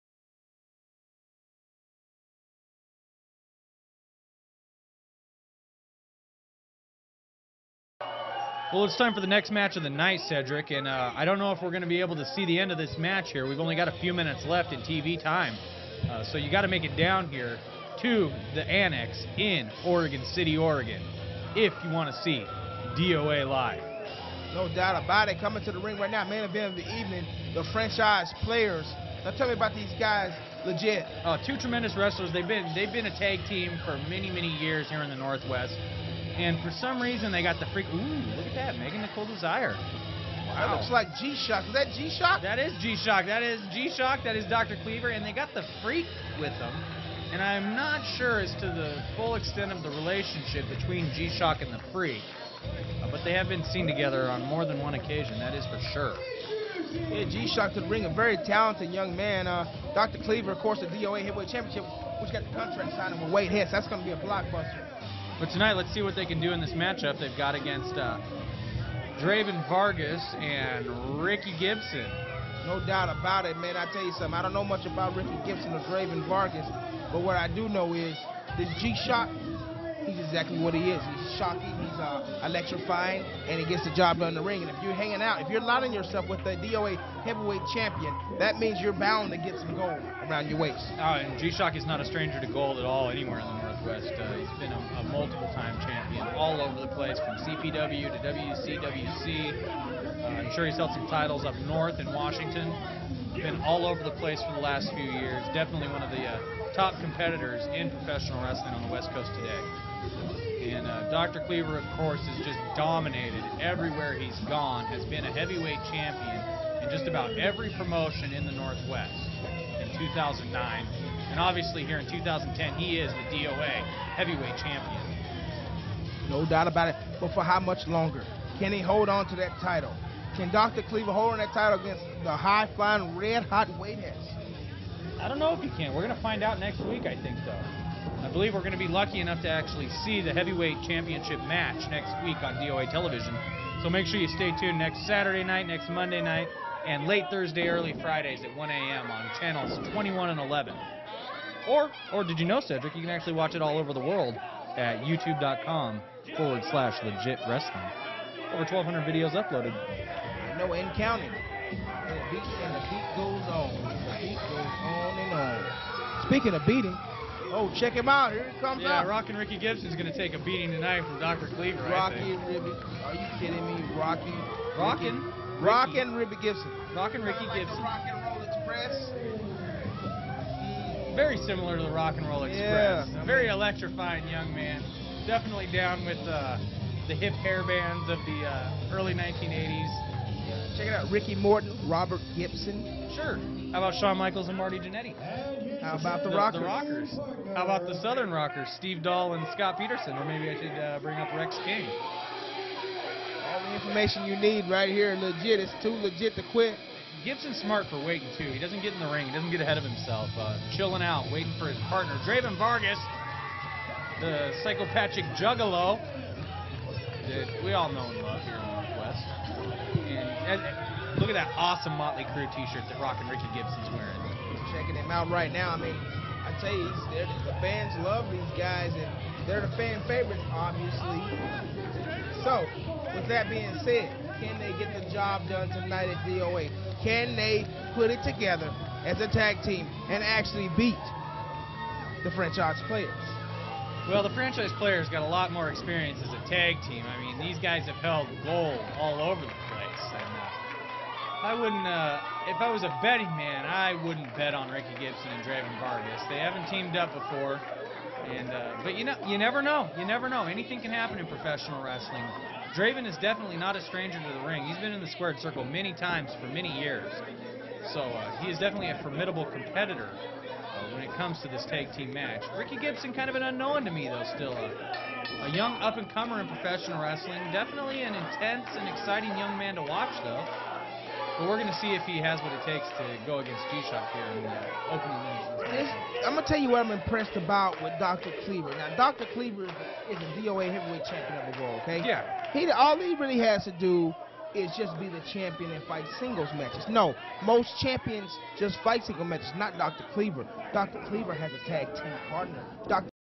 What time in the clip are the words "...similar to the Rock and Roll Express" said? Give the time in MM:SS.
03:01.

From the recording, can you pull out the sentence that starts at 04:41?
But we're going to see if he has what it takes to go against G-Shock here in the opening minutes.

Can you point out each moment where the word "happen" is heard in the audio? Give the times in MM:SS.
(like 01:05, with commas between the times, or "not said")
04:20.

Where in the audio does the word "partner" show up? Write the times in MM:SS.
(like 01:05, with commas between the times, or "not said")
03:31, 05:02.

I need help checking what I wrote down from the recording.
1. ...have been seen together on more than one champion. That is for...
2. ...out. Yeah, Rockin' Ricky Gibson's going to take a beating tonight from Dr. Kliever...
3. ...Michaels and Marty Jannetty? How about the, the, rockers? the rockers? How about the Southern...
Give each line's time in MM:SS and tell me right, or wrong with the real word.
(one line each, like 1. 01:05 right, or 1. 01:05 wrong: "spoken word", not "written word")
1. 00:53 wrong: "occasion", not "champion"
2. 02:49 right
3. 03:14 right.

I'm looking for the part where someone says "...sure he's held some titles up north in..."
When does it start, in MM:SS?
01:40.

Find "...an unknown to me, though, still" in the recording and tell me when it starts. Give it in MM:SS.
04:33.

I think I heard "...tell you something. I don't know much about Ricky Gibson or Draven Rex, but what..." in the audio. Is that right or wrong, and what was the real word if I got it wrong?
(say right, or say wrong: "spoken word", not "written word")
wrong: "Vargas", not "Rex".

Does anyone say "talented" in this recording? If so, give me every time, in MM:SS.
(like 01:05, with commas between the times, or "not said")
00:58.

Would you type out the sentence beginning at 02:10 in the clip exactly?
Kliever hold on that title against the high flying, red hot weightheads?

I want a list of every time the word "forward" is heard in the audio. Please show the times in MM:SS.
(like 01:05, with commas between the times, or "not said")
02:36.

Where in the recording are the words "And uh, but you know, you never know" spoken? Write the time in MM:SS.
04:18.